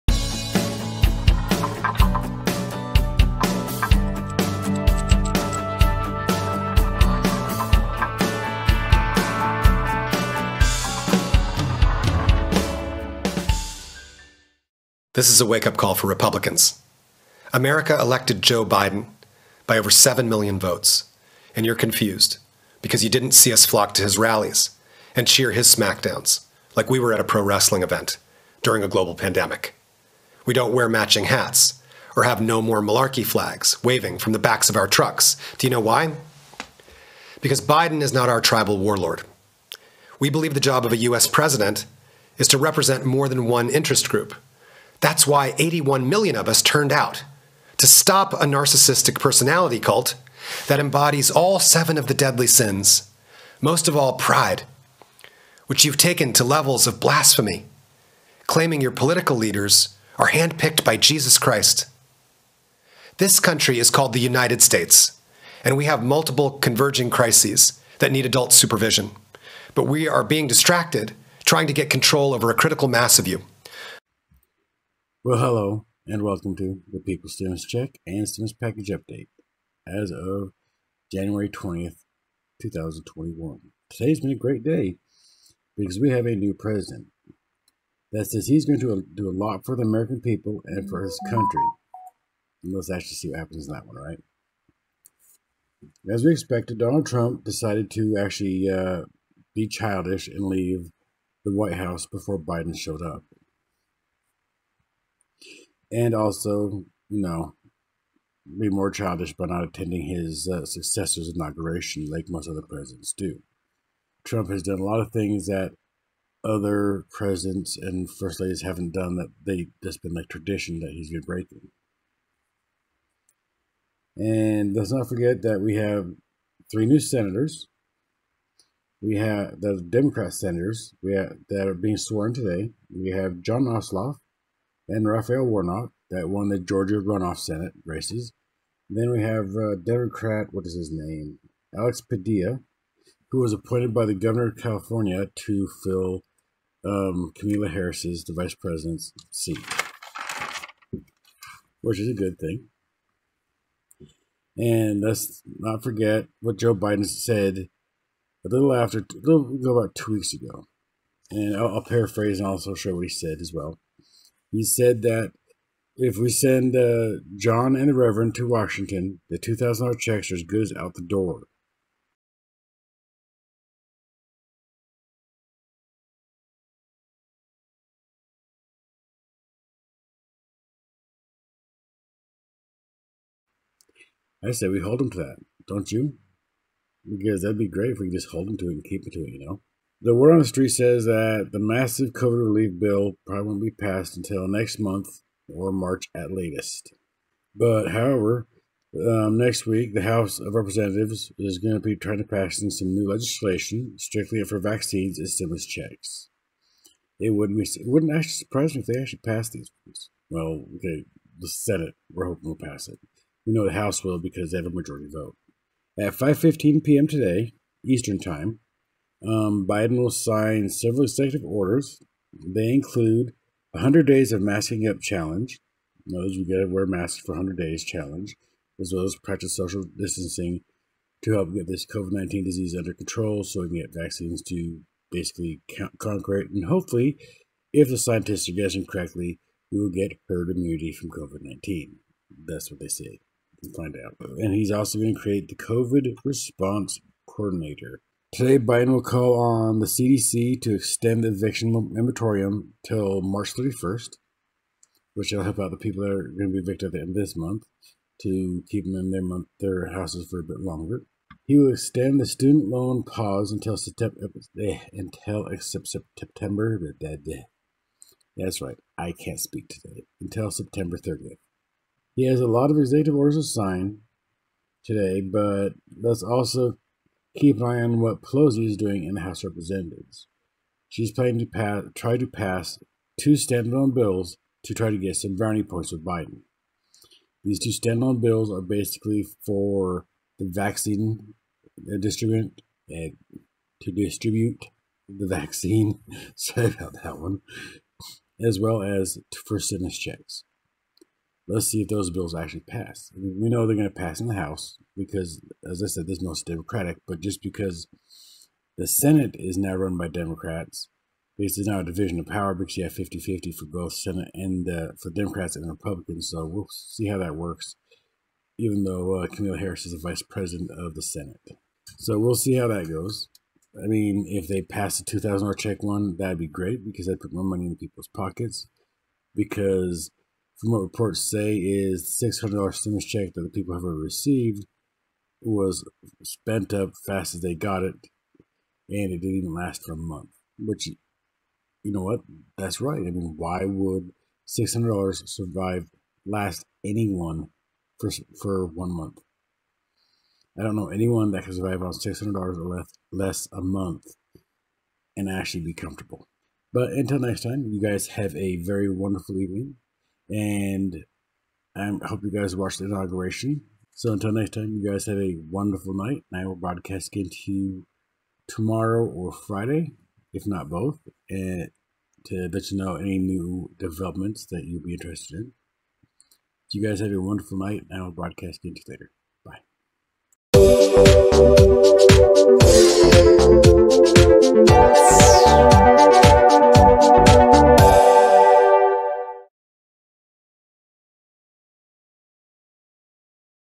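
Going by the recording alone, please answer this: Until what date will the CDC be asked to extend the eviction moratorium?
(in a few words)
March 31st.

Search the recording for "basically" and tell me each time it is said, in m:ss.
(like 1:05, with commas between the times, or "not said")
3:55, 4:48.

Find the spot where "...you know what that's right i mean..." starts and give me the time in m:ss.
5:40.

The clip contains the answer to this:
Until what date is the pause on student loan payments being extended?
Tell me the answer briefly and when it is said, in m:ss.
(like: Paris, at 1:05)
September 30th, at 4:30.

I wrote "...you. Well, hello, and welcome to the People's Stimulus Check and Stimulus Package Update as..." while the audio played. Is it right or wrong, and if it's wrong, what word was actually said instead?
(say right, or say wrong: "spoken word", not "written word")
right.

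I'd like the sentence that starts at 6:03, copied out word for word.
So until next time, you guys have a wonderful night.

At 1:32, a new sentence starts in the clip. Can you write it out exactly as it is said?
And let's actually see what happens in that one, right?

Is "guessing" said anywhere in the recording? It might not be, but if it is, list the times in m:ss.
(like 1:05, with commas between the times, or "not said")
3:58.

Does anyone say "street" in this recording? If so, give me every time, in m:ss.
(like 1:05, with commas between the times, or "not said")
3:10.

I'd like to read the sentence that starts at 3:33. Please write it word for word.
We know the House will because they have a majority vote.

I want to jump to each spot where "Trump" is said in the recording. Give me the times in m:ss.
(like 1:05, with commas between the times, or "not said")
1:37, 1:54.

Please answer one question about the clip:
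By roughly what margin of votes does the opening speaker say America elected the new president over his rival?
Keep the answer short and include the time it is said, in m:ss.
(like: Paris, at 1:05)
over 7 million, at 0:19.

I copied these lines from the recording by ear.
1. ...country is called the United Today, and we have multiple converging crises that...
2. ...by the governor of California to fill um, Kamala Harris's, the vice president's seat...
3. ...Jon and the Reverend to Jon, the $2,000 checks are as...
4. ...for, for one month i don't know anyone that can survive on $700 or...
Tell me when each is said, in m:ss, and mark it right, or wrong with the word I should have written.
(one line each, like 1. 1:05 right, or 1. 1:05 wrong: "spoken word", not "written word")
1. 1:03 wrong: "States", not "Today"
2. 2:23 right
3. 2:47 wrong: "Washington", not "Jon"
4. 5:47 wrong: "600", not "700".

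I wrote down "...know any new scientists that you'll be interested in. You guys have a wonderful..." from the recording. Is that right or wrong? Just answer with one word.
wrong.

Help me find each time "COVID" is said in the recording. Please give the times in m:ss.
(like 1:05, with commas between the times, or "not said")
3:12, 3:51, 4:01, 4:05.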